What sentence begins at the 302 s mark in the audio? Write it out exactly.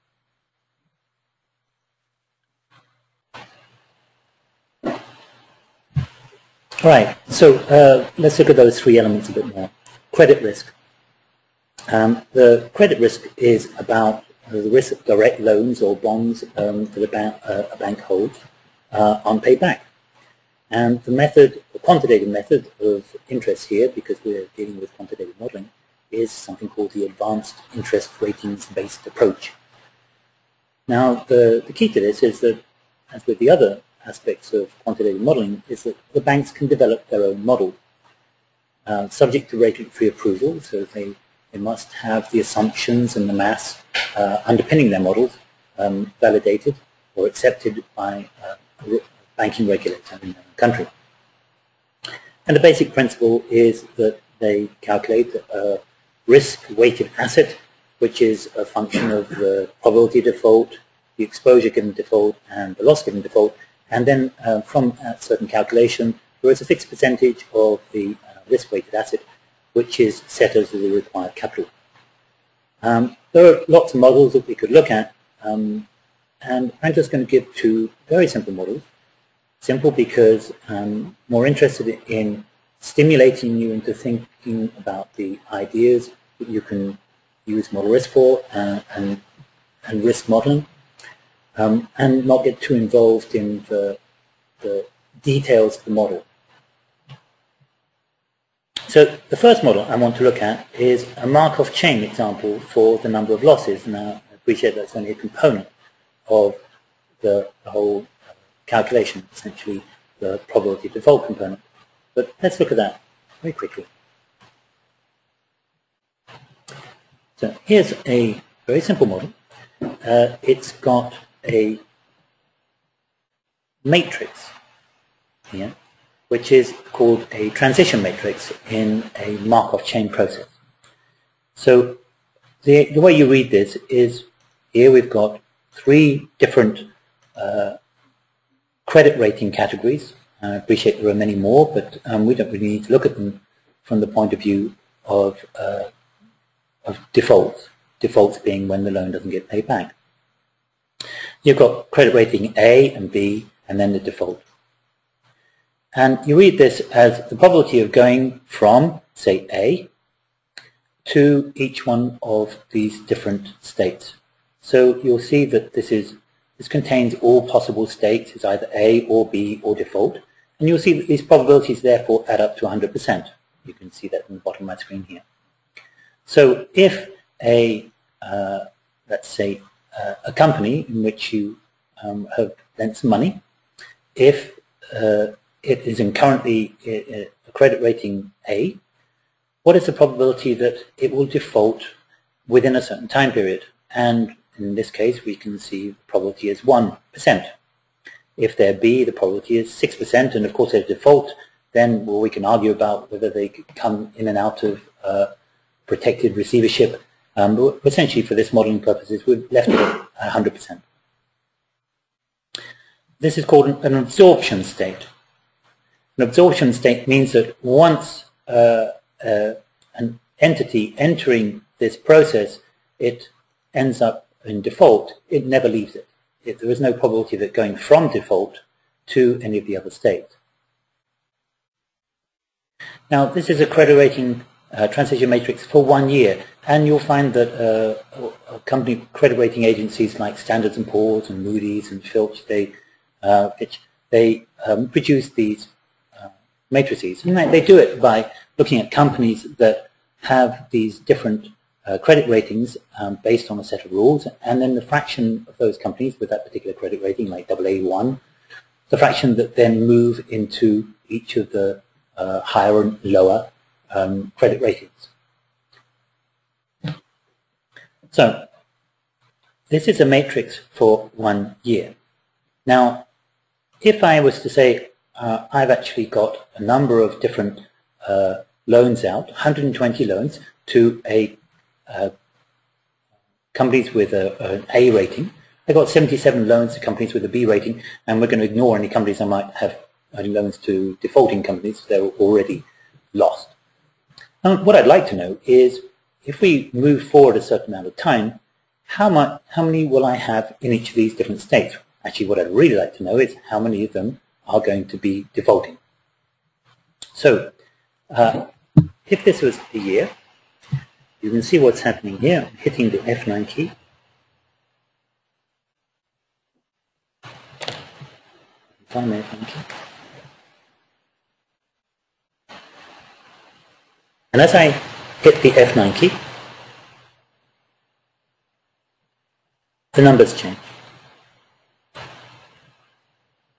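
Actually, what I'd really like to know is how many of them are going to be defaulting.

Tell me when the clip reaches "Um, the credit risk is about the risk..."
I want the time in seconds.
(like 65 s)
11 s.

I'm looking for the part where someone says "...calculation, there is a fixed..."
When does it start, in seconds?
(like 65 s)
65 s.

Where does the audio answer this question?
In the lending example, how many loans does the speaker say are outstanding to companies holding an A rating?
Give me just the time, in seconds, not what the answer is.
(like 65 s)
279 s.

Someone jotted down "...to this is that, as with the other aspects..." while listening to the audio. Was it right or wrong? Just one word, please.
right.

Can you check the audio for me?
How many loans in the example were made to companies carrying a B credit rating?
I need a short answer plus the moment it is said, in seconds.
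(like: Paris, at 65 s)
77, at 285 s.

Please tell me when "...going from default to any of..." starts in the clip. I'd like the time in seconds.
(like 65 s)
227 s.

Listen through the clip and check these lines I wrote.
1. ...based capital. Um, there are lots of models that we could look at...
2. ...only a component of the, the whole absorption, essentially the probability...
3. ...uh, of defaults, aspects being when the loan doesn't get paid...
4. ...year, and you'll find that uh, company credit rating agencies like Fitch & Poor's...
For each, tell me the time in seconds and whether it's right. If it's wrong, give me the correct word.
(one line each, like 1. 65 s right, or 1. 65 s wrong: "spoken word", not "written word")
1. 70 s wrong: "required", not "based"
2. 104 s wrong: "calculation", not "absorption"
3. 145 s wrong: "defaults", not "aspects"
4. 236 s wrong: "Standards", not "Fitch".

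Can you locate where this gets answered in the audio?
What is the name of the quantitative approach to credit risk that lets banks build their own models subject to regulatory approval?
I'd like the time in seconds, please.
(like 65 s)
27 s.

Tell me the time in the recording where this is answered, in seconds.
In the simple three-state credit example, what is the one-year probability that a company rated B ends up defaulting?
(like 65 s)
199 s.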